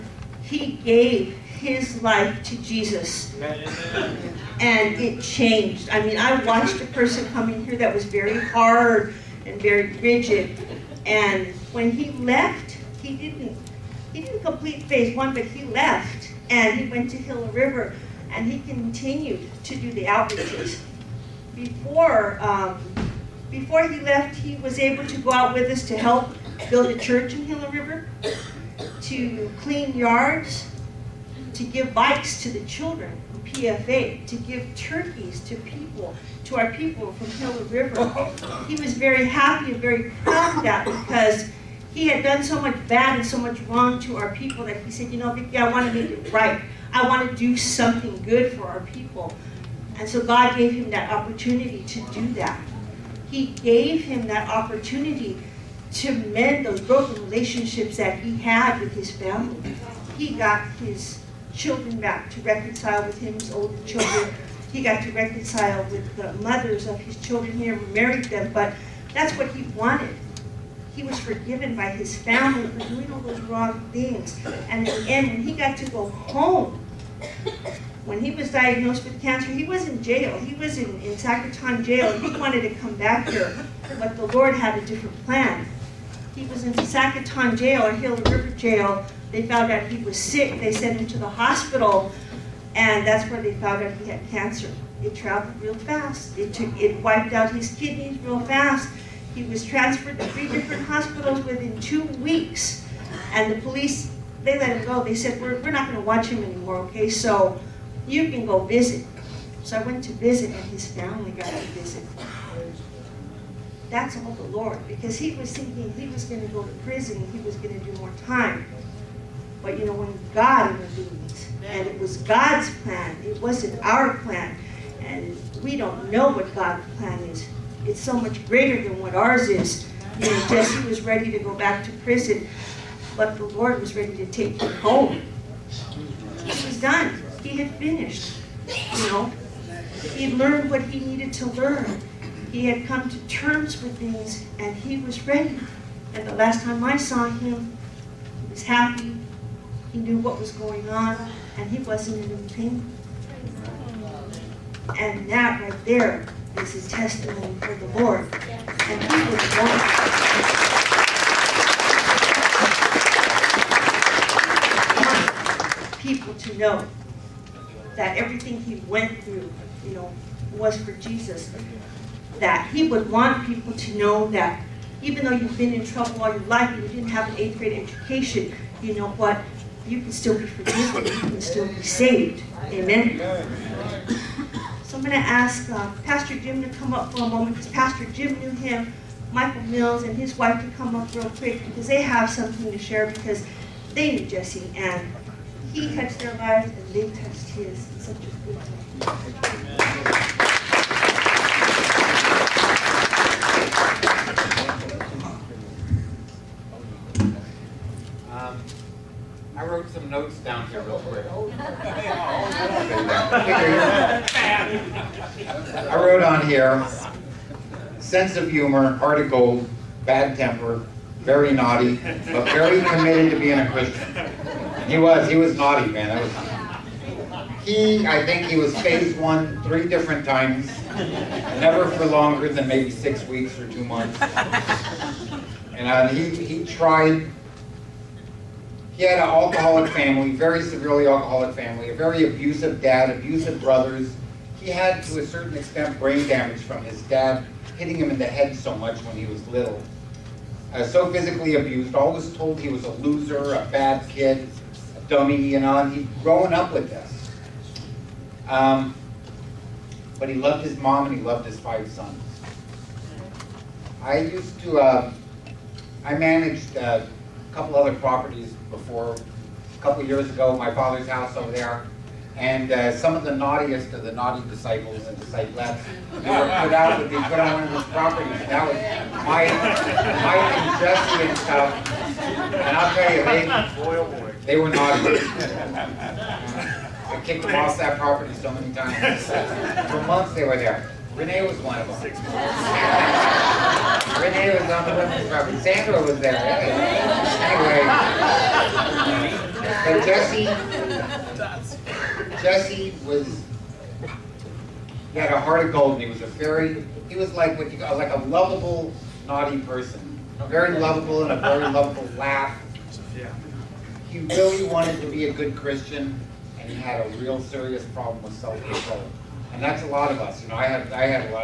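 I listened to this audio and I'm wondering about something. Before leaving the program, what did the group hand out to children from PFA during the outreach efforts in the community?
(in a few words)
bikes.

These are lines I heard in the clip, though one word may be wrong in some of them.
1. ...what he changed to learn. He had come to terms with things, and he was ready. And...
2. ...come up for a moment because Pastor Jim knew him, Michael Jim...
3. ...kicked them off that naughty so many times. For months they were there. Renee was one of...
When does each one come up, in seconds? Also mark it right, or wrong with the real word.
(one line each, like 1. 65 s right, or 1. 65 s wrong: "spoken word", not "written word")
1. 140 s wrong: "needed", not "changed"
2. 186 s wrong: "Mills", not "Jim"
3. 287 s wrong: "property", not "naughty".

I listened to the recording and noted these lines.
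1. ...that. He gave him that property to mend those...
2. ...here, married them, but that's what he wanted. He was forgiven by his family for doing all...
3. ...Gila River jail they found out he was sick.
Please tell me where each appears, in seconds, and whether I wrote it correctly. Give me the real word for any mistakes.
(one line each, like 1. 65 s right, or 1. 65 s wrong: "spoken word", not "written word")
1. 52 s wrong: "opportunity", not "property"
2. 67 s right
3. 87 s right.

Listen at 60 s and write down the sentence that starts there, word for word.
He got his children back to reconcile with him, his older children.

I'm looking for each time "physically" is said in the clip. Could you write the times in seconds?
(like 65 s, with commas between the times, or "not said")
251 s.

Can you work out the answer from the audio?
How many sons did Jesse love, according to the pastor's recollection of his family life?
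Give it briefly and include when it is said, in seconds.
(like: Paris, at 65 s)
5, at 261 s.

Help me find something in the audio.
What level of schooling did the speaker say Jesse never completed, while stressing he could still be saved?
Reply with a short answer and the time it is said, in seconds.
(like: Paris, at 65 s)
eighth grade, at 177 s.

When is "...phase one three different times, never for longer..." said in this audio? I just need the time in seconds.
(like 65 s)
228 s.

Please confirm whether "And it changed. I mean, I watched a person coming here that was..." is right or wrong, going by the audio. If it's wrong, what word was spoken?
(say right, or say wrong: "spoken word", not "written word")
right.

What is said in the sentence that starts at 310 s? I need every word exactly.
Very lovable and a very lovable laugh.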